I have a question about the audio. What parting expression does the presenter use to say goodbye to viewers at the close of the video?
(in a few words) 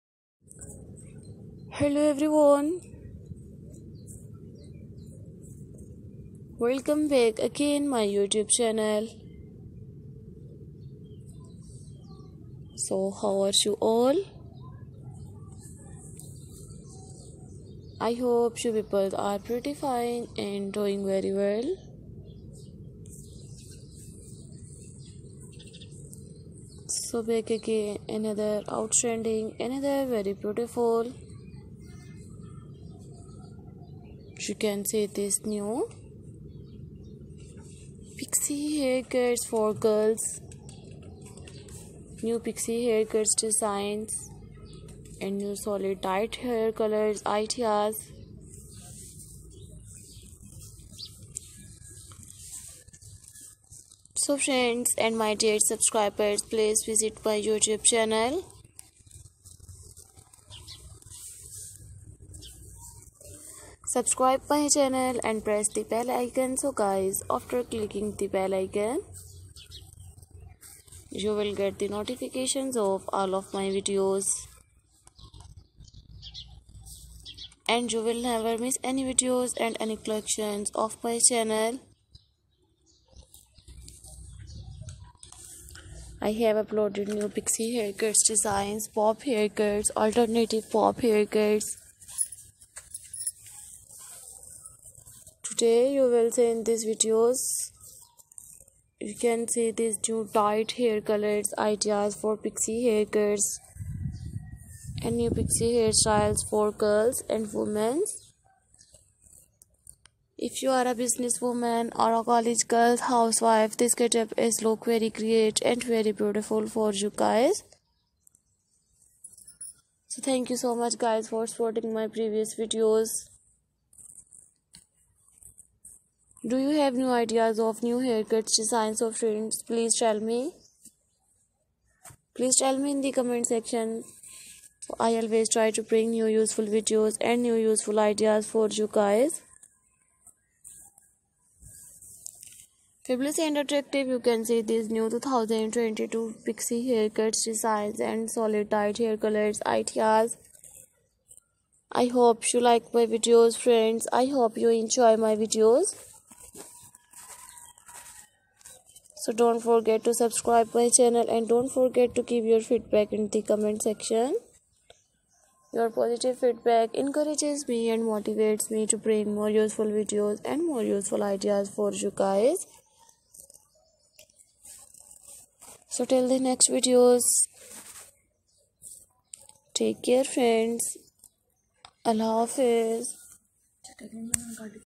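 Allah Hafiz.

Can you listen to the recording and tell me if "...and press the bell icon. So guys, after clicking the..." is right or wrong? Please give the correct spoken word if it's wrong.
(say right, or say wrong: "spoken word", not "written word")
right.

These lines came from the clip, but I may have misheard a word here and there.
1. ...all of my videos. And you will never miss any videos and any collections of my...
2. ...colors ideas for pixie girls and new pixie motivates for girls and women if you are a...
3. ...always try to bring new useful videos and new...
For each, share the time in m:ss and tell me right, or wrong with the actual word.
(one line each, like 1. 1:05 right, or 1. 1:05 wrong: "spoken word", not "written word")
1. 1:13 right
2. 1:41 wrong: "hairstyles", not "motivates"
3. 2:15 right.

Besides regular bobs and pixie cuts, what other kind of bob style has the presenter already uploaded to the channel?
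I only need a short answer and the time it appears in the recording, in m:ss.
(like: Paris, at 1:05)
Alternative bob haircuts, at 1:29.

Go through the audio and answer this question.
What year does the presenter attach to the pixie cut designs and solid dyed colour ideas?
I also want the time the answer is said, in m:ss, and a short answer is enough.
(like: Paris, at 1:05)
2022, at 2:25.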